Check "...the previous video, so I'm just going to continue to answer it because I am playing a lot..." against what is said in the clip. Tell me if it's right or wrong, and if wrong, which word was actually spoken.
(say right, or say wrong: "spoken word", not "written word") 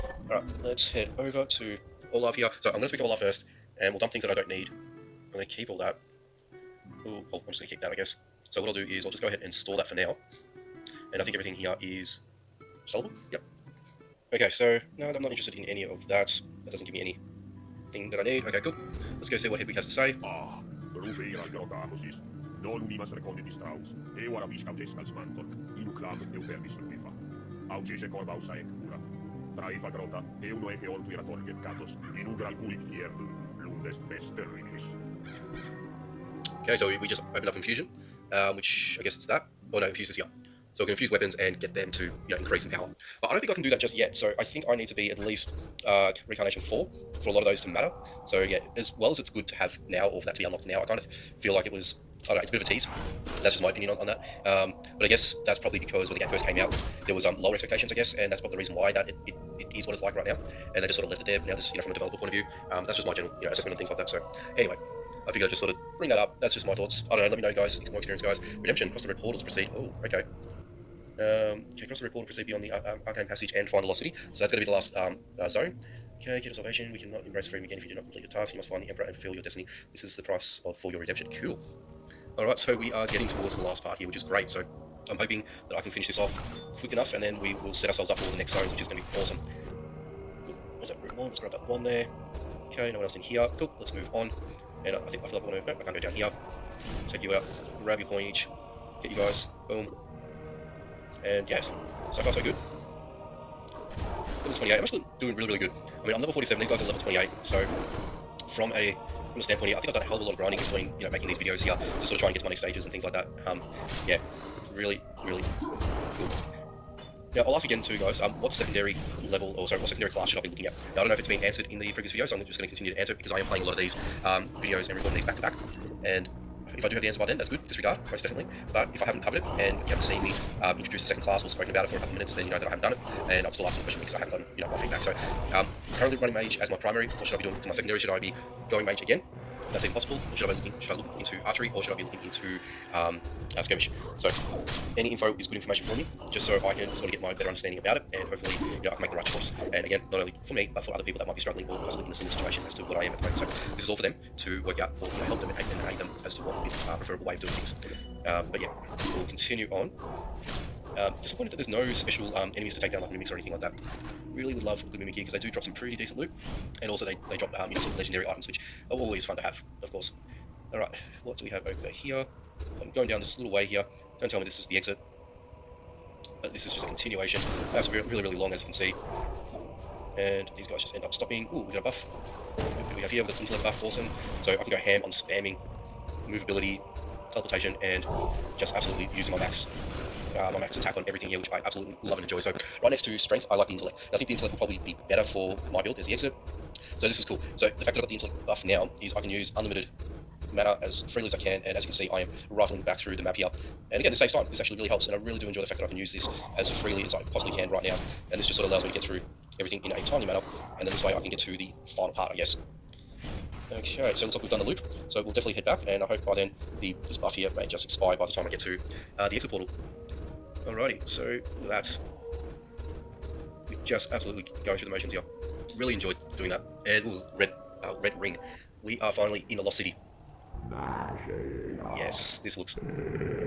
right.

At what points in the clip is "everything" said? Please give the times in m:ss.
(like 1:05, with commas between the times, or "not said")
0:11, 3:11, 3:29.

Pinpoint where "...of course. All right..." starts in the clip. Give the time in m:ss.
2:49.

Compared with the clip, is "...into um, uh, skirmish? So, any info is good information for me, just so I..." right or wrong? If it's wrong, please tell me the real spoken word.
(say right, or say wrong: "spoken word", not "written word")
right.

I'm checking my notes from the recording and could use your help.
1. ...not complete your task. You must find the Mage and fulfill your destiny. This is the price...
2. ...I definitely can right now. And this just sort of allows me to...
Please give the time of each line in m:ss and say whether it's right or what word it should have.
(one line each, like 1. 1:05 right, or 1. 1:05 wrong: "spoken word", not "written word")
1. 1:17 wrong: "Emperor", not "Mage"
2. 3:27 wrong: "possibly", not "definitely".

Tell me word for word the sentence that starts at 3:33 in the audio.
Okay, so it looks like we've done the loop.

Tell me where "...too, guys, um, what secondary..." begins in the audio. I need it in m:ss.
1:57.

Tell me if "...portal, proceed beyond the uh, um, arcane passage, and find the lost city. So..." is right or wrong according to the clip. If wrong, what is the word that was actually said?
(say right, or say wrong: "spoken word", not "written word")
right.